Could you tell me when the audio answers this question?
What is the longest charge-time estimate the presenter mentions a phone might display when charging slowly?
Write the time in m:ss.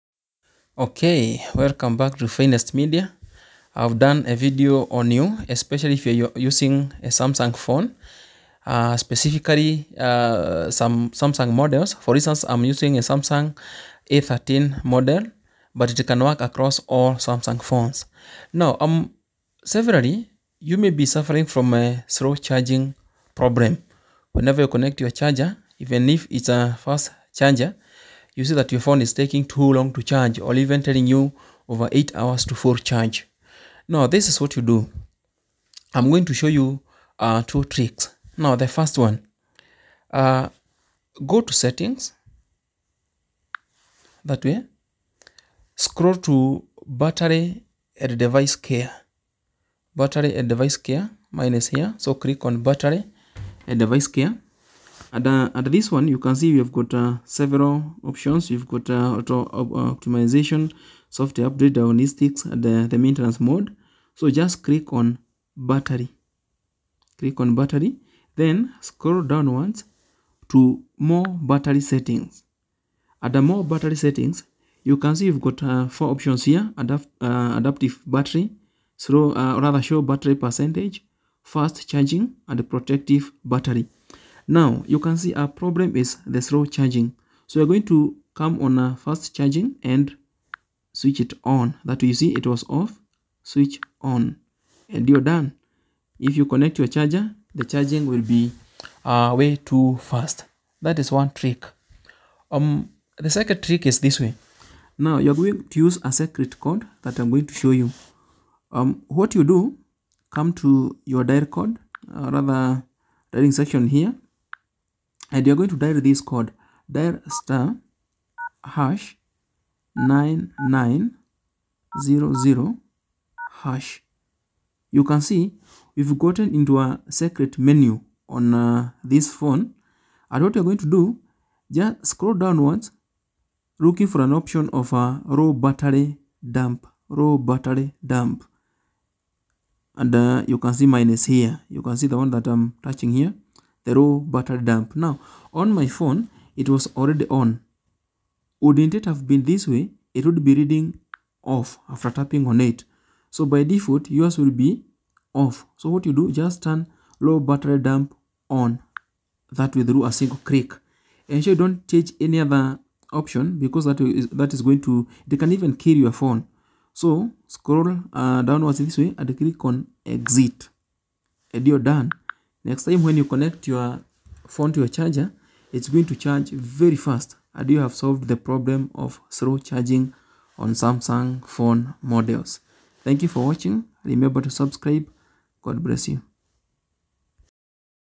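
0:31.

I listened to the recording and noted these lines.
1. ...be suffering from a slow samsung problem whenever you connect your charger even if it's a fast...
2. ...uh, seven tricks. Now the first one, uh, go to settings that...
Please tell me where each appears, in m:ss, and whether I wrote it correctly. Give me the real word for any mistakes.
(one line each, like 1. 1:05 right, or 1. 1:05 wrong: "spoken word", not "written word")
1. 0:20 wrong: "charging", not "samsung"
2. 0:37 wrong: "two", not "seven".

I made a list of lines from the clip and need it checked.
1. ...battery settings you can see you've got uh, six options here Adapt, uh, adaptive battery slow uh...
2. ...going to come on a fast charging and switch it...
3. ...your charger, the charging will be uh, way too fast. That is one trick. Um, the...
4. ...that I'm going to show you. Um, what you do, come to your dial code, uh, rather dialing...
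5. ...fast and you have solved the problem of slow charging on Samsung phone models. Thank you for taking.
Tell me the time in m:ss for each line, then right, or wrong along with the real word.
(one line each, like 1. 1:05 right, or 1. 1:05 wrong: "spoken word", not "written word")
1. 1:13 wrong: "four", not "six"
2. 1:27 right
3. 1:36 right
4. 1:47 right
5. 2:56 wrong: "watching", not "taking".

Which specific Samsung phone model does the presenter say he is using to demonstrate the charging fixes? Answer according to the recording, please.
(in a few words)
Samsung A13.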